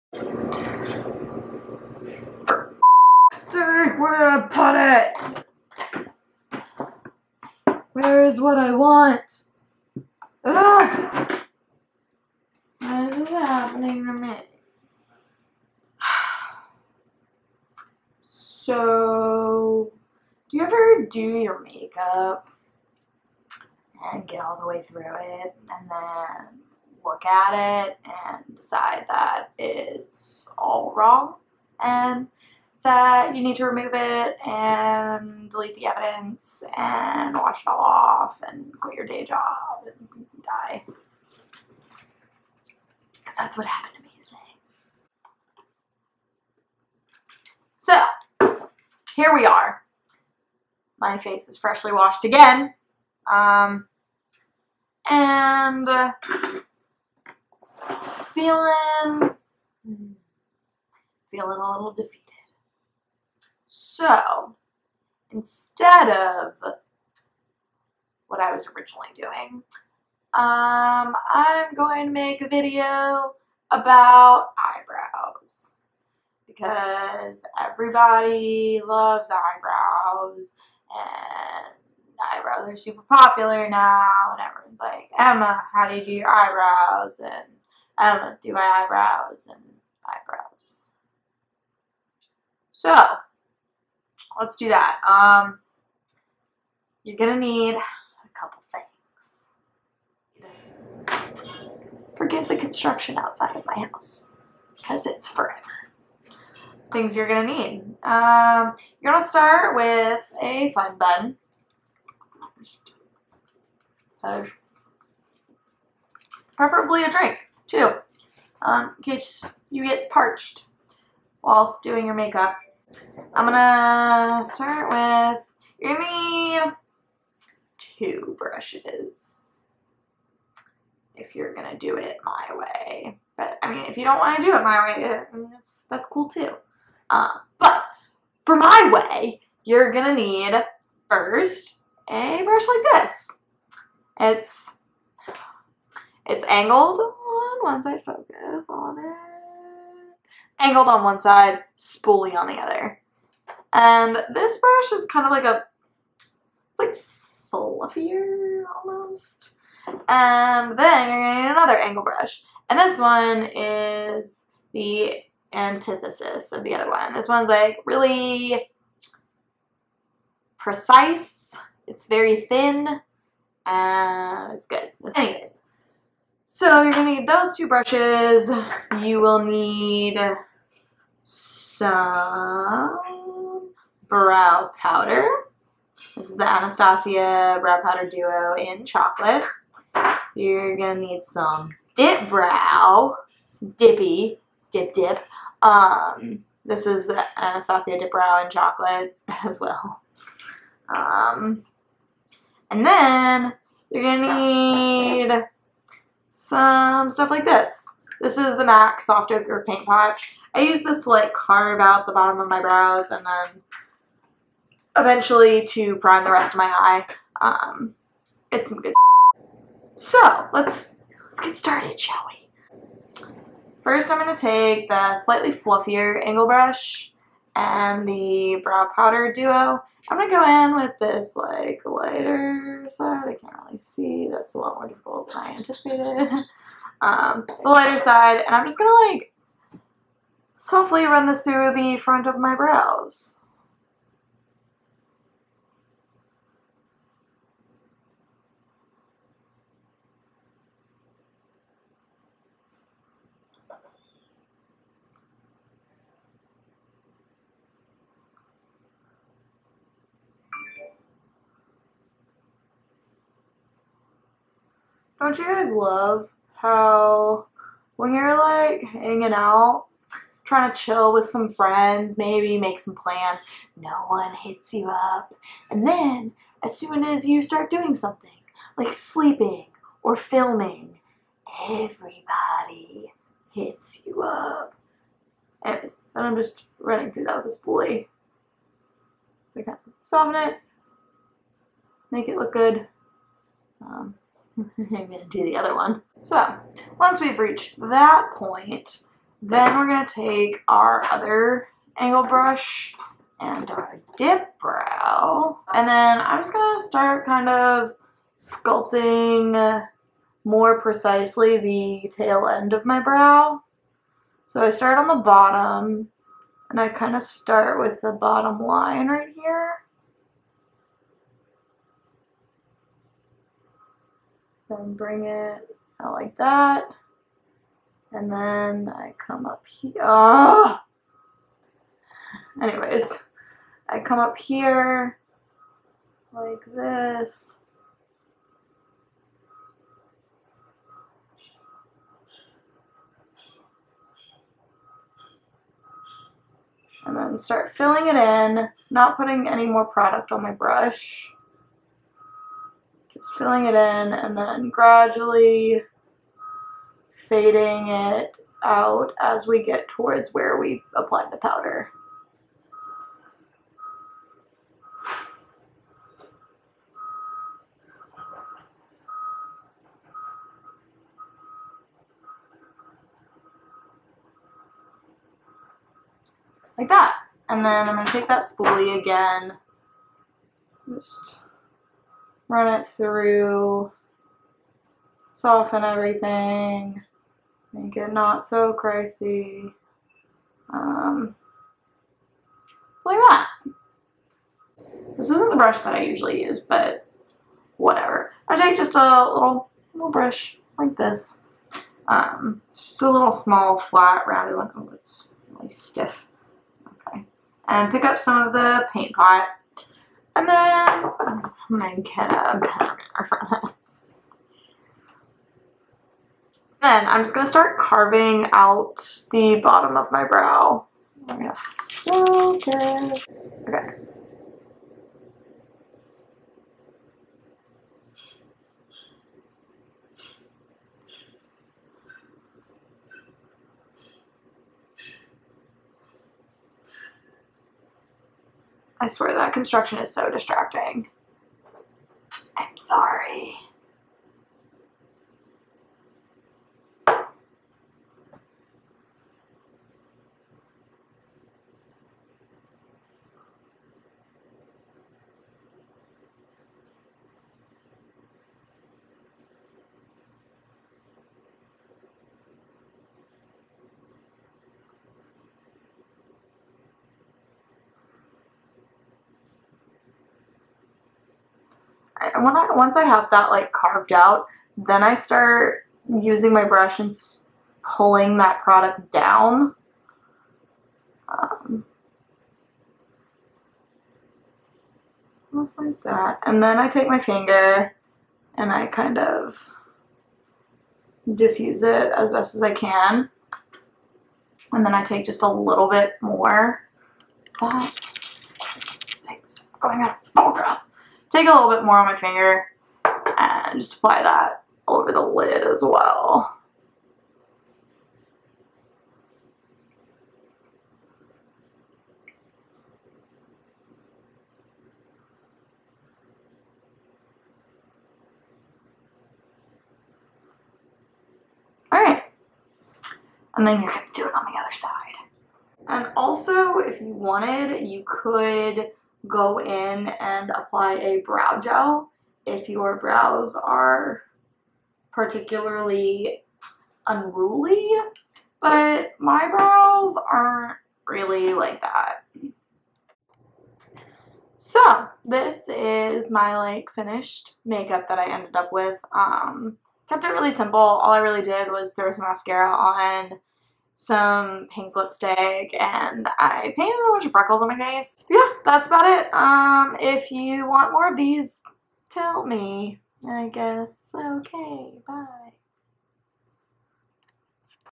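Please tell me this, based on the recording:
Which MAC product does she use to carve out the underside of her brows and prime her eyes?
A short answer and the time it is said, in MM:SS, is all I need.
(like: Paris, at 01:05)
Soft Ochre Paint Pot, at 03:29.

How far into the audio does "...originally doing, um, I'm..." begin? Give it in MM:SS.
01:08.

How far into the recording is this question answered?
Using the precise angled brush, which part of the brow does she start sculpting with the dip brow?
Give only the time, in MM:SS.
05:12.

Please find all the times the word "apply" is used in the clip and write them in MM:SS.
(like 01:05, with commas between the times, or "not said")
06:00, 08:23, 08:50.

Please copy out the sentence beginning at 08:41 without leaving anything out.
Alright, and then you're going to do it on the other side.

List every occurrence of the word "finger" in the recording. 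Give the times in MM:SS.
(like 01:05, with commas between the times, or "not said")
08:07, 08:22.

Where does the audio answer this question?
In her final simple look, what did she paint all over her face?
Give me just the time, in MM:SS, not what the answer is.
09:17.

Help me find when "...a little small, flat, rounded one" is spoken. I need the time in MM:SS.
06:43.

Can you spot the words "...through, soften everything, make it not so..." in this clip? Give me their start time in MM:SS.
06:22.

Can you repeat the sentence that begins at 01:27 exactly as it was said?
And Emma, do my eyebrows and eyebrows.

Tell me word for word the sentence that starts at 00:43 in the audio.
Because that's what happened to me today.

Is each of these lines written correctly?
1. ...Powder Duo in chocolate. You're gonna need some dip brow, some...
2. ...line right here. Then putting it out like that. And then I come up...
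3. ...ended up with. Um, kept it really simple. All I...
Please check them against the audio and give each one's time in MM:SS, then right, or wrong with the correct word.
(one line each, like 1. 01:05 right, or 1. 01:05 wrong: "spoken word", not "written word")
1. 03:07 right
2. 05:18 wrong: "bring", not "putting"
3. 09:08 right.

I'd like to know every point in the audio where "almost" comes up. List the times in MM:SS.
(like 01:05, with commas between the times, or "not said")
02:38, 08:05.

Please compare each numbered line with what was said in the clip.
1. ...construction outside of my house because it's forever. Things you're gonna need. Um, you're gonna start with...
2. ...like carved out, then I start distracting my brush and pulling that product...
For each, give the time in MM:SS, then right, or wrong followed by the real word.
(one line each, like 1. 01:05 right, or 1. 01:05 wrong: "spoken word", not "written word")
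1. 01:42 right
2. 07:53 wrong: "using", not "distracting".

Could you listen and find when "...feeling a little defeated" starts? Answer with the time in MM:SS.
01:01.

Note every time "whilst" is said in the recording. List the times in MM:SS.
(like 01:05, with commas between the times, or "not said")
02:01.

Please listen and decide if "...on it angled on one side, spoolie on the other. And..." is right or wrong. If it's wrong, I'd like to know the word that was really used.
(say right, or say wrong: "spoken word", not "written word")
right.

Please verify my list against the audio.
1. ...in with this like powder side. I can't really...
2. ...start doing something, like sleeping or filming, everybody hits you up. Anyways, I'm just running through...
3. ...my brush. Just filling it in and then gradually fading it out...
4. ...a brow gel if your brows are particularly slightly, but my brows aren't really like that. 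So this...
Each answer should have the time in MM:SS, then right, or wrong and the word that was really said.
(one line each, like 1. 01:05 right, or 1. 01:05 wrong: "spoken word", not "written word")
1. 03:50 wrong: "lighter", not "powder"
2. 04:37 right
3. 05:50 right
4. 08:50 wrong: "unruly", not "slightly".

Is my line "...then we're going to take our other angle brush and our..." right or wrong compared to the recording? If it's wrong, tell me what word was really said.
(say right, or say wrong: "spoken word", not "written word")
right.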